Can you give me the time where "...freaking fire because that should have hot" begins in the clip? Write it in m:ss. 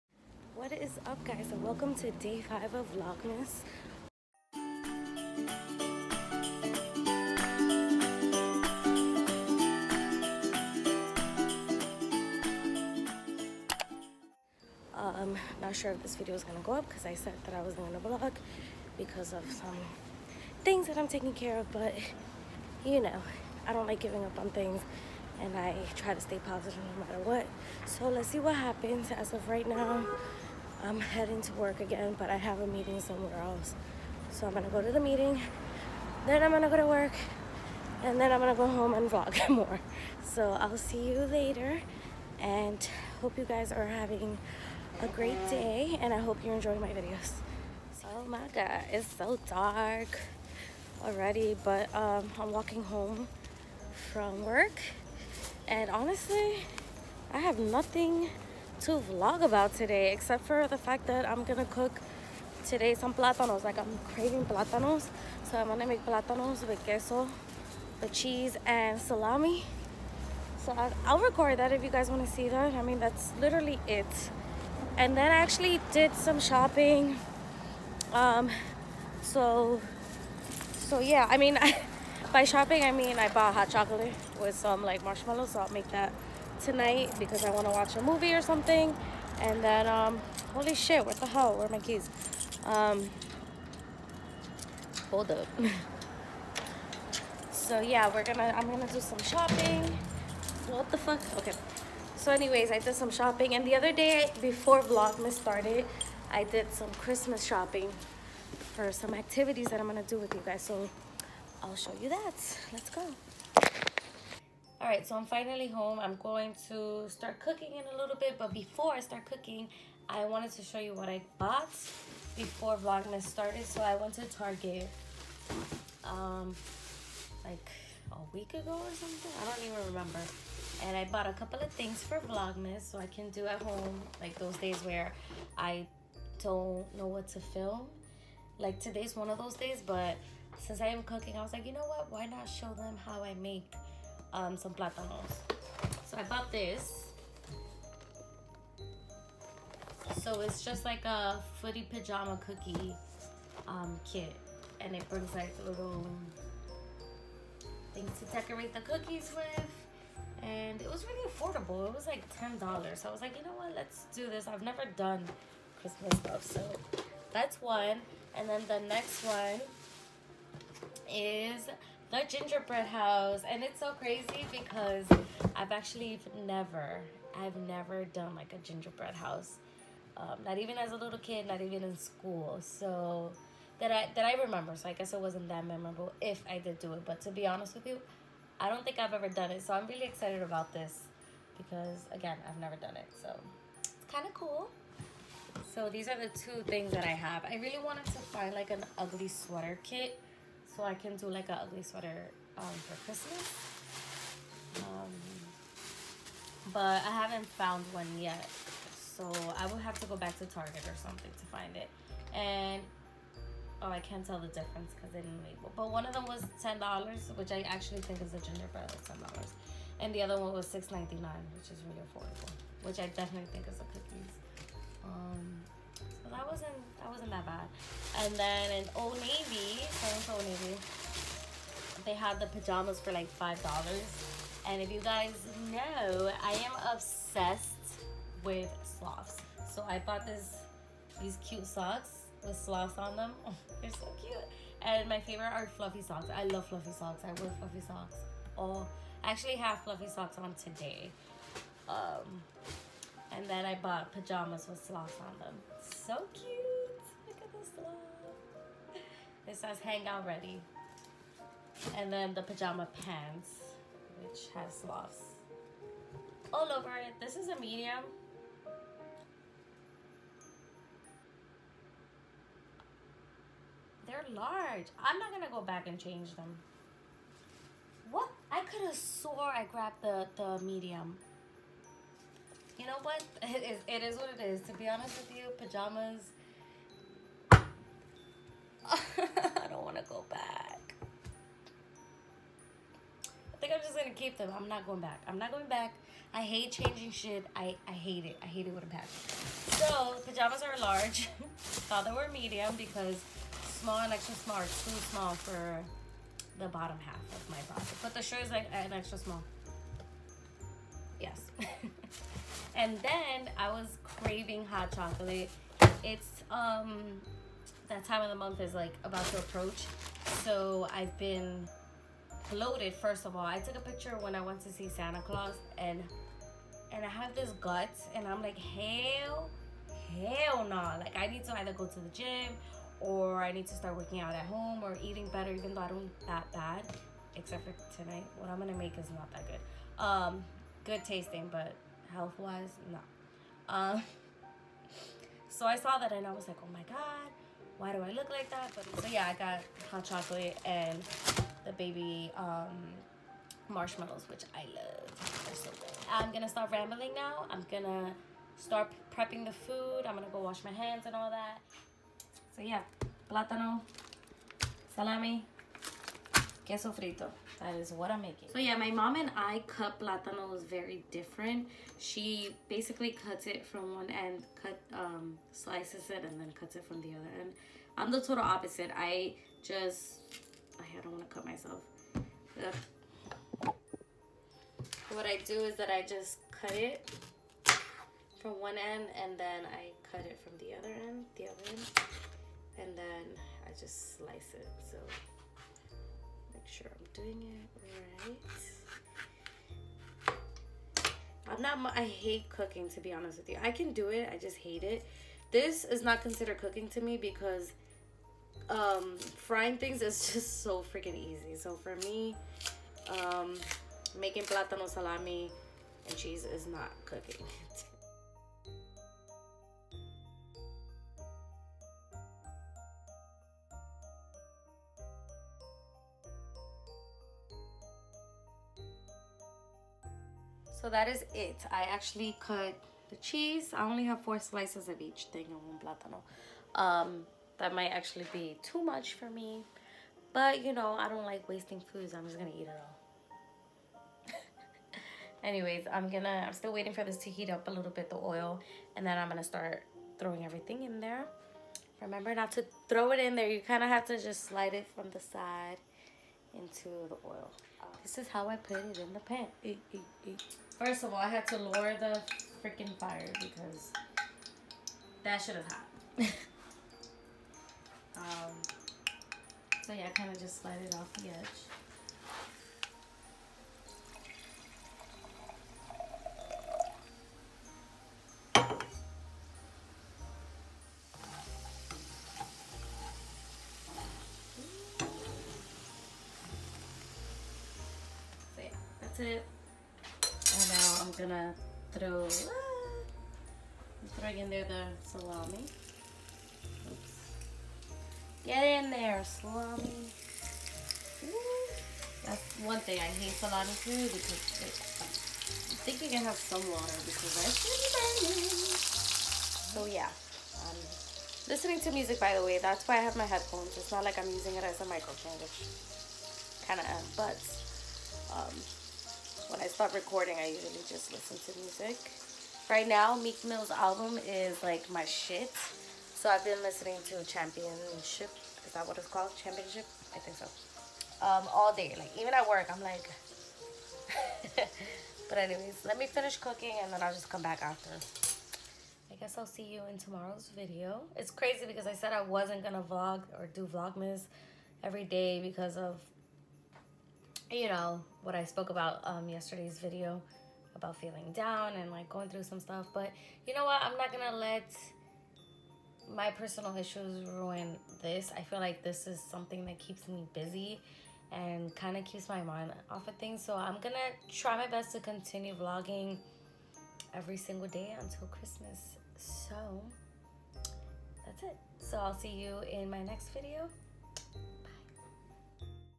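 7:42.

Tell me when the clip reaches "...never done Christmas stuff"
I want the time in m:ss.
2:44.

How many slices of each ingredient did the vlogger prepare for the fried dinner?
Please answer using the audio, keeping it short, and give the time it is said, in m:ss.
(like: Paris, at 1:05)
4, at 7:14.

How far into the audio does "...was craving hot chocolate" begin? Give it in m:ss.
5:13.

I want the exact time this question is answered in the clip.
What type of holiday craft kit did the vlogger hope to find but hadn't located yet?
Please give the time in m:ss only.
3:18.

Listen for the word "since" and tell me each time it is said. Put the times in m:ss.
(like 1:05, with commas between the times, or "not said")
2:20.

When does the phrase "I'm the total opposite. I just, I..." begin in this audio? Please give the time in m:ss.
6:17.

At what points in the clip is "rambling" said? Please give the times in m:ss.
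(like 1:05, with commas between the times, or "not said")
5:56.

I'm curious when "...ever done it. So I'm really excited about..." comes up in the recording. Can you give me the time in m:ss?
3:09.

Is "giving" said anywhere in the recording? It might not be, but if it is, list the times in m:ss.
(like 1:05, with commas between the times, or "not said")
0:23.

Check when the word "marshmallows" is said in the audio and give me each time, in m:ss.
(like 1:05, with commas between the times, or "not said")
1:25, 5:53.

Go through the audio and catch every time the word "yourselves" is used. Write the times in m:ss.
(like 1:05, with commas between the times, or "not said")
not said.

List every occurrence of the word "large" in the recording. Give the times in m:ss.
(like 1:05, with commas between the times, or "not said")
4:34, 5:00.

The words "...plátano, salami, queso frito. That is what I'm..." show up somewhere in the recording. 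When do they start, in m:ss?
6:03.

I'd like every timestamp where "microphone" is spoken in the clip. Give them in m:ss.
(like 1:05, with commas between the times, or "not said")
8:34.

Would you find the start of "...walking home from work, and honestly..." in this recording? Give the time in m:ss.
0:52.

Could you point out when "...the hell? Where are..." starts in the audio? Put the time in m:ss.
1:31.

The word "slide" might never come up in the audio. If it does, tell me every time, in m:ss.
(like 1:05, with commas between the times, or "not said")
7:34, 7:50.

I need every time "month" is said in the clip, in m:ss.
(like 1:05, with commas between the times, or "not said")
5:18.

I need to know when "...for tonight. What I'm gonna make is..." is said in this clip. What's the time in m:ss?
5:37.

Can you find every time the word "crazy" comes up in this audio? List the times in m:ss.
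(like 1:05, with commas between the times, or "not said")
2:53, 9:01.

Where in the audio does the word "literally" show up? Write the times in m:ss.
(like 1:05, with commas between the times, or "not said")
1:13.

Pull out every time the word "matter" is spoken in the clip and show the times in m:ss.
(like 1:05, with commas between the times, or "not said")
0:27.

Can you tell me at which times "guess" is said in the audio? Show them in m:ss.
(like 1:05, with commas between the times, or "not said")
3:04, 8:59.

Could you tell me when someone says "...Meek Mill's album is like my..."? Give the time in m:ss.
8:43.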